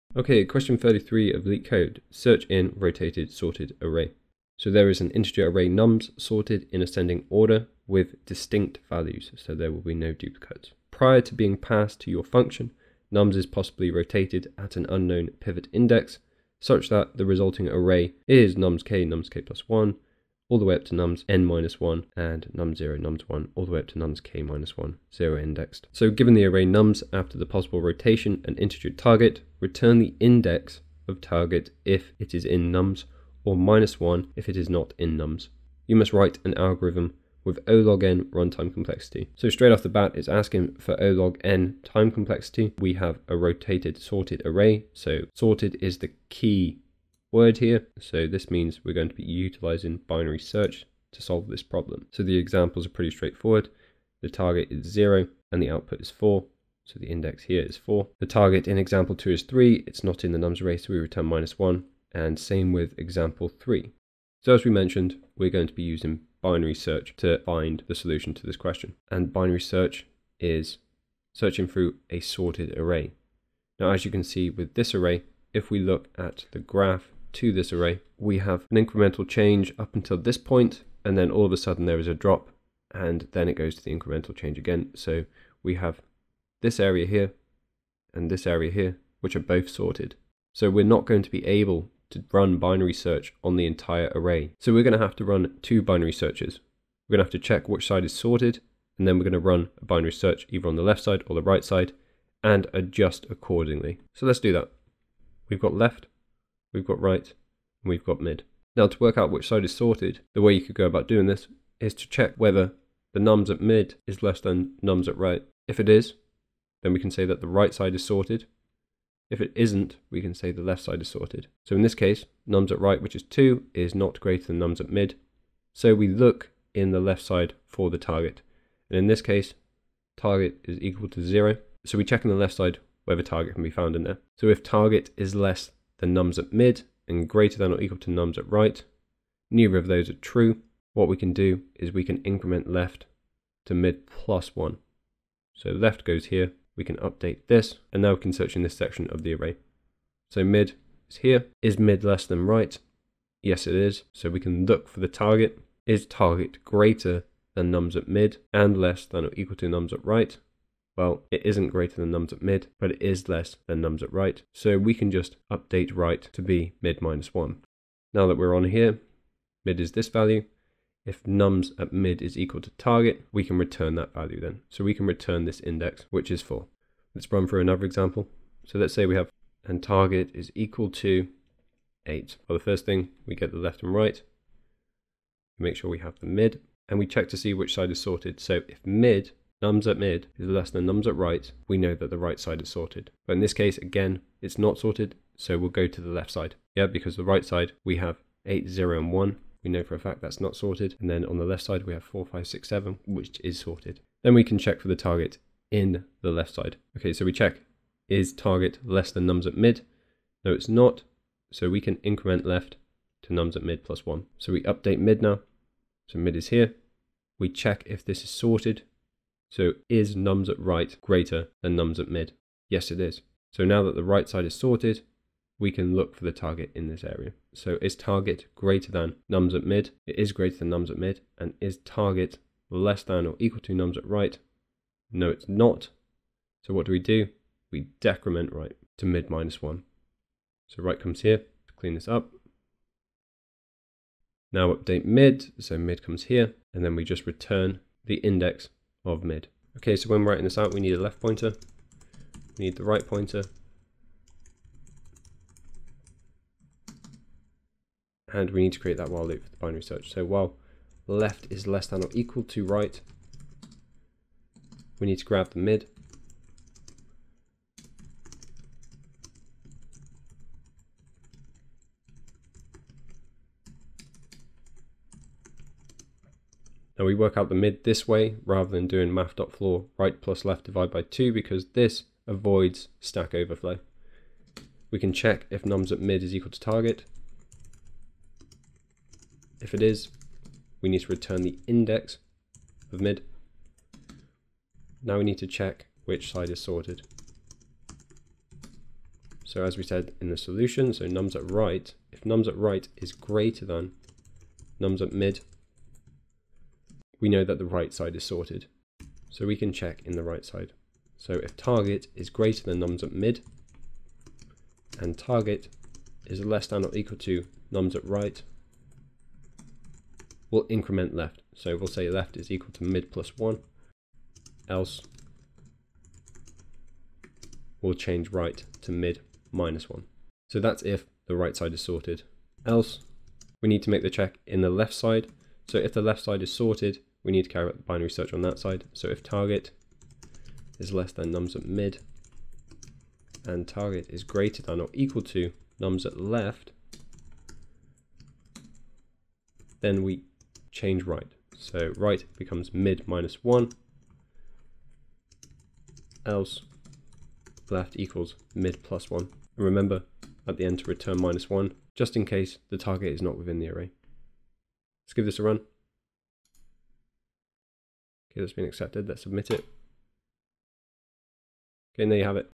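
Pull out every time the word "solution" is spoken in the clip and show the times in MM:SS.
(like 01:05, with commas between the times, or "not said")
01:07, 05:00.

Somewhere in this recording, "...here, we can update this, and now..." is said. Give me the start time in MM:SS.
02:26.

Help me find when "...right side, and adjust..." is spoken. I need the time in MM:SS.
01:41.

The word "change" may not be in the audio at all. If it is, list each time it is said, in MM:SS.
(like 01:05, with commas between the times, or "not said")
01:19, 01:24, 05:27, 05:50.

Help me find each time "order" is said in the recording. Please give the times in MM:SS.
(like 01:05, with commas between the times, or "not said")
00:07.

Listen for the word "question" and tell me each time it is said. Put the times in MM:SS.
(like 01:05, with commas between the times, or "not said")
00:00, 01:08.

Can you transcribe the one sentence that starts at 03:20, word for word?
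And then on the left side, we have 4, 5, 6, 7, which is sorted.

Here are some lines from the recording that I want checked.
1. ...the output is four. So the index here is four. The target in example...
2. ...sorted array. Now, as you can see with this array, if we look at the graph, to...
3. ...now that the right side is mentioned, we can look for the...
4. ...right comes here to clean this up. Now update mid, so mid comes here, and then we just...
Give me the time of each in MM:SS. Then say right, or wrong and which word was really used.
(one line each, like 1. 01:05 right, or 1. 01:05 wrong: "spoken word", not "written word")
1. 00:55 right
2. 01:12 right
3. 03:43 wrong: "sorted", not "mentioned"
4. 04:00 right.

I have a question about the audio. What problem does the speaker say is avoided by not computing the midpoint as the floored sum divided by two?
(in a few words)
stack overflow.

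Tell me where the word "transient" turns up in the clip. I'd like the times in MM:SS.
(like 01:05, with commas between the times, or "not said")
not said.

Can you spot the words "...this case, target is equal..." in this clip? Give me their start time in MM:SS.
02:09.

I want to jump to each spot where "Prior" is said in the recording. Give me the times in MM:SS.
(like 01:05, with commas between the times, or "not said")
00:10.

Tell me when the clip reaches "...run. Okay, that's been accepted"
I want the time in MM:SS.
06:05.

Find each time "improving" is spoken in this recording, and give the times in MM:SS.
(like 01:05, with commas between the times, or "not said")
not said.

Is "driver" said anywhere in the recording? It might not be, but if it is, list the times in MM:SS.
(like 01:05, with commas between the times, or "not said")
not said.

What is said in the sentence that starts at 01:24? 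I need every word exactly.
So we have this area here and this area here, which are both sorted.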